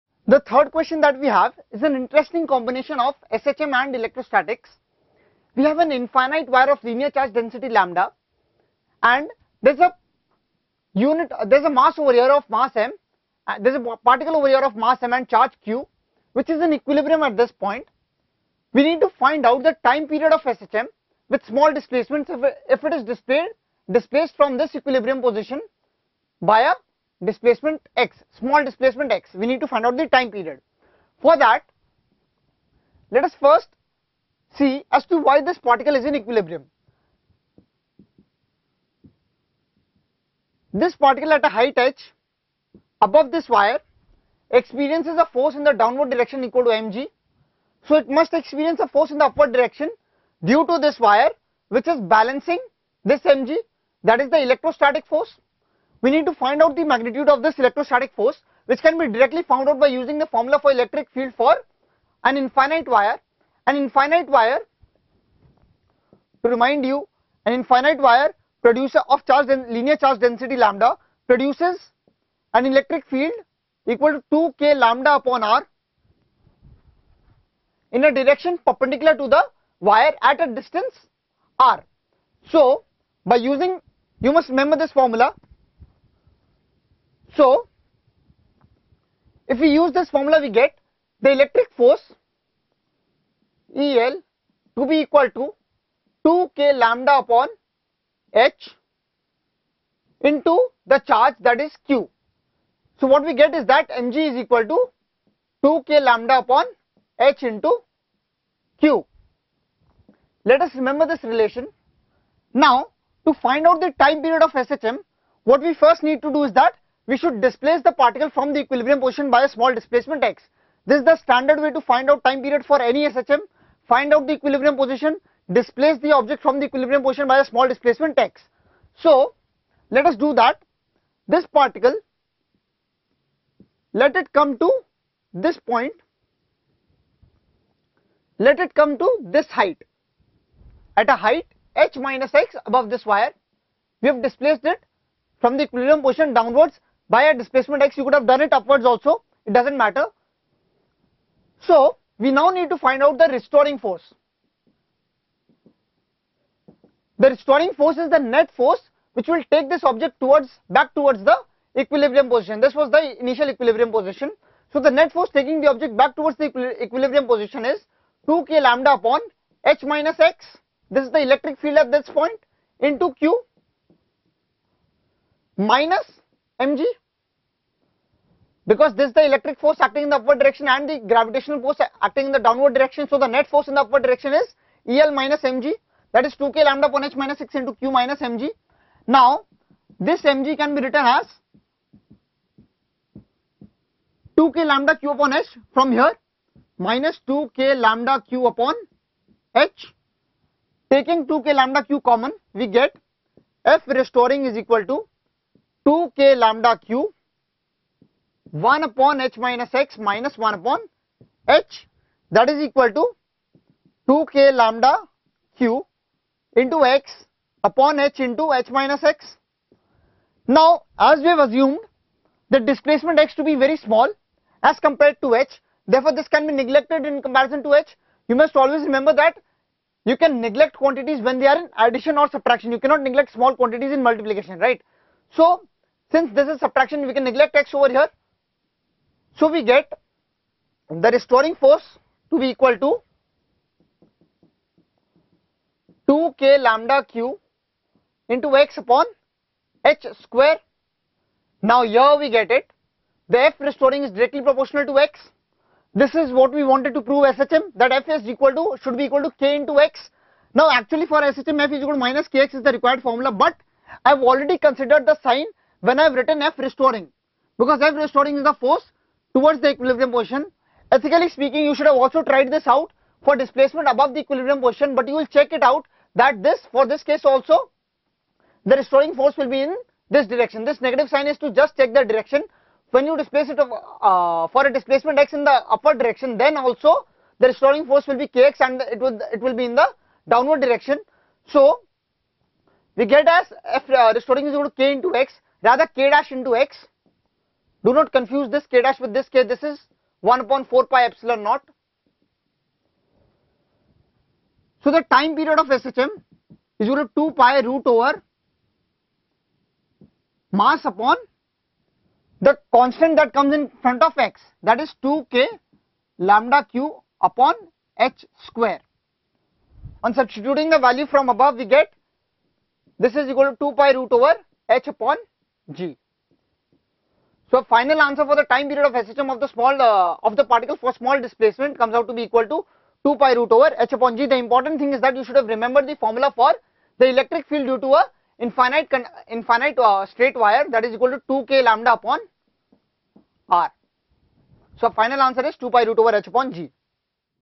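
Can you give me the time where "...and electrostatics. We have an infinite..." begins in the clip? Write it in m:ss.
0:03.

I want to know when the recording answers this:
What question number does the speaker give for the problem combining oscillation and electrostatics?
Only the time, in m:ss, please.
0:00.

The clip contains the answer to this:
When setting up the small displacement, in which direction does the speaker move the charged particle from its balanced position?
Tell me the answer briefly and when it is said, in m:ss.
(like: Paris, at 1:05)
Downwards, at 2:26.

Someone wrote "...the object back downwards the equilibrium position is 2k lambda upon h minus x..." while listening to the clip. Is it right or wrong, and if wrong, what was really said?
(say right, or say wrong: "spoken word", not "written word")
wrong: "towards", not "downwards".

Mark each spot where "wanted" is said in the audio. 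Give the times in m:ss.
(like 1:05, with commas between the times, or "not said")
4:16.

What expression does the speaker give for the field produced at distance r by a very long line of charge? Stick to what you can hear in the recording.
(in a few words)
2kλ/r.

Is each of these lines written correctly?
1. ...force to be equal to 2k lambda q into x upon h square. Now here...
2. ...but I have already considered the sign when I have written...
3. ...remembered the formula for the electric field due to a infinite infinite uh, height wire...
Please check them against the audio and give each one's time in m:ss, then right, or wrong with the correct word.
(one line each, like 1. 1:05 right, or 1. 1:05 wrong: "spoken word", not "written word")
1. 4:01 right
2. 4:23 right
3. 5:35 wrong: "straight", not "height".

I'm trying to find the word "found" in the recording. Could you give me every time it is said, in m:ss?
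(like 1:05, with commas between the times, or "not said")
0:59.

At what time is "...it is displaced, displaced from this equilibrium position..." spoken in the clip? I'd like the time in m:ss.
0:22.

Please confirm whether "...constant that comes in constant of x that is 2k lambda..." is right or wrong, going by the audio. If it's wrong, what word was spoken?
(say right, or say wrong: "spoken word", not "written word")
wrong: "front", not "constant".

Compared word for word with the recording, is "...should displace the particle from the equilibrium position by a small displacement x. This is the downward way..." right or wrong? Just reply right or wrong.
wrong.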